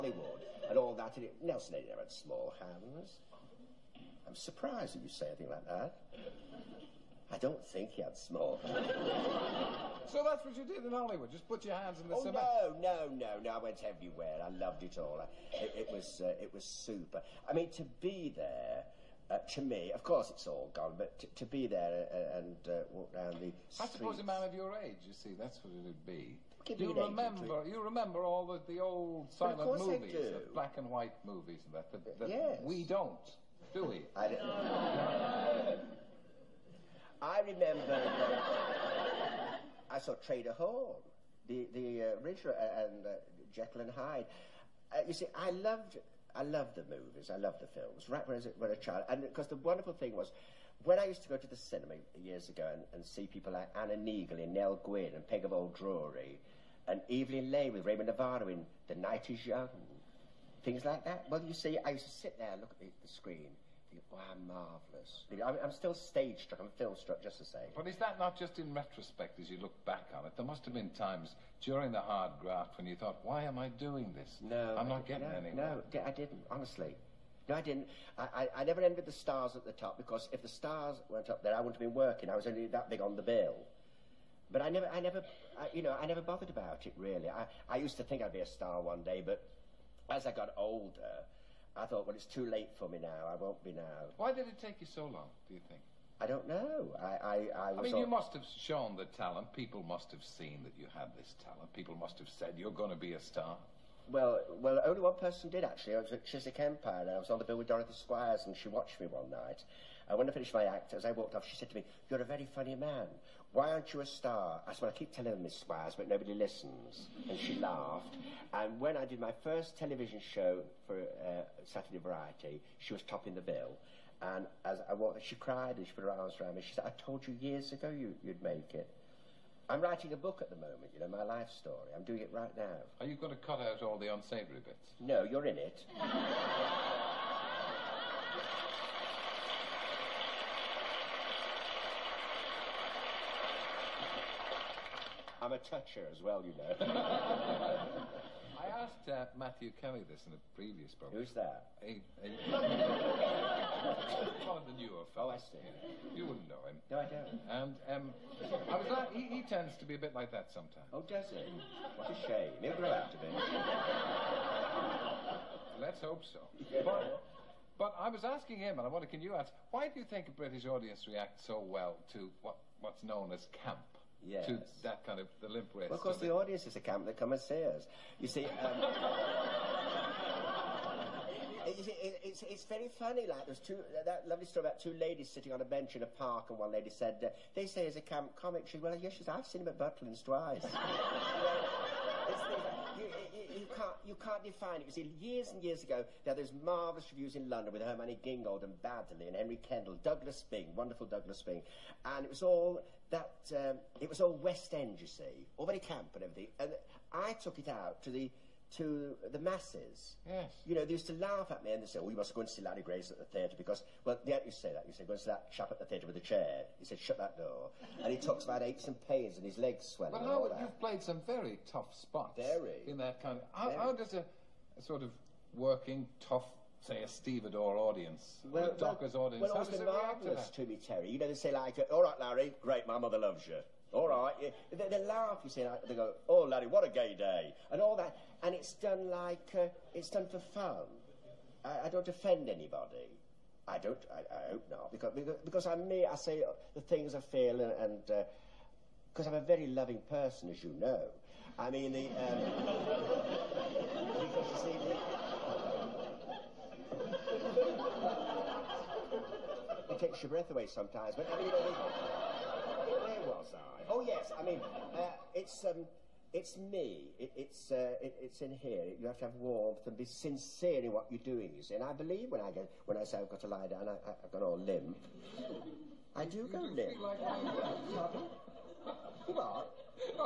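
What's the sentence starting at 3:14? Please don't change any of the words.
You see, years and years ago.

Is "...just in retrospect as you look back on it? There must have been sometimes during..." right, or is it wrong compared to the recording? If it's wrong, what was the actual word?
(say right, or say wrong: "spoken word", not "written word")
wrong: "times", not "sometimes".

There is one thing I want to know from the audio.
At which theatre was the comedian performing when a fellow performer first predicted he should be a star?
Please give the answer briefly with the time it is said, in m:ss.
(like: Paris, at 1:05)
Chiswick Empire, at 1:46.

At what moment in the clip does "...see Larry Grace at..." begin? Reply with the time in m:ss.
3:32.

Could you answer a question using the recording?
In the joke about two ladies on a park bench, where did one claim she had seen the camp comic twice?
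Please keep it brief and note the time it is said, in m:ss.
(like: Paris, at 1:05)
Butlins, at 3:09.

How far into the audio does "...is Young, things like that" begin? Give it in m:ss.
0:59.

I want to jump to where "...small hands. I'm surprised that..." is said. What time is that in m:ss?
0:02.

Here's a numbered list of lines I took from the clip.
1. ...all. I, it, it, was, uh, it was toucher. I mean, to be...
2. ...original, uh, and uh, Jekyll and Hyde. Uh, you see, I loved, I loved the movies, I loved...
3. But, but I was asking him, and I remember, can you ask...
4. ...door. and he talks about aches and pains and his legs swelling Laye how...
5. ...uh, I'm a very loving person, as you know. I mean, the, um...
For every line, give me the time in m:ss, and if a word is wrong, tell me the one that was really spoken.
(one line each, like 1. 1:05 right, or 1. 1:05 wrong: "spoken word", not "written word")
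1. 0:14 wrong: "super", not "toucher"
2. 0:42 right
3. 2:46 wrong: "wonder", not "remember"
4. 3:37 wrong: "But", not "Laye"
5. 4:09 right.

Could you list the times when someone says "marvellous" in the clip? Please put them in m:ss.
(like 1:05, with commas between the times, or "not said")
1:04, 3:16.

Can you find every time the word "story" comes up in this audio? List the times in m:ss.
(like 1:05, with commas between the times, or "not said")
2:11, 3:04.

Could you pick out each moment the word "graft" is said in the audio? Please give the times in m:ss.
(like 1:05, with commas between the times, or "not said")
1:12.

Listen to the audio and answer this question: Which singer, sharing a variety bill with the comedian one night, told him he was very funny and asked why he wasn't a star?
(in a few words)
Dorothy Squires.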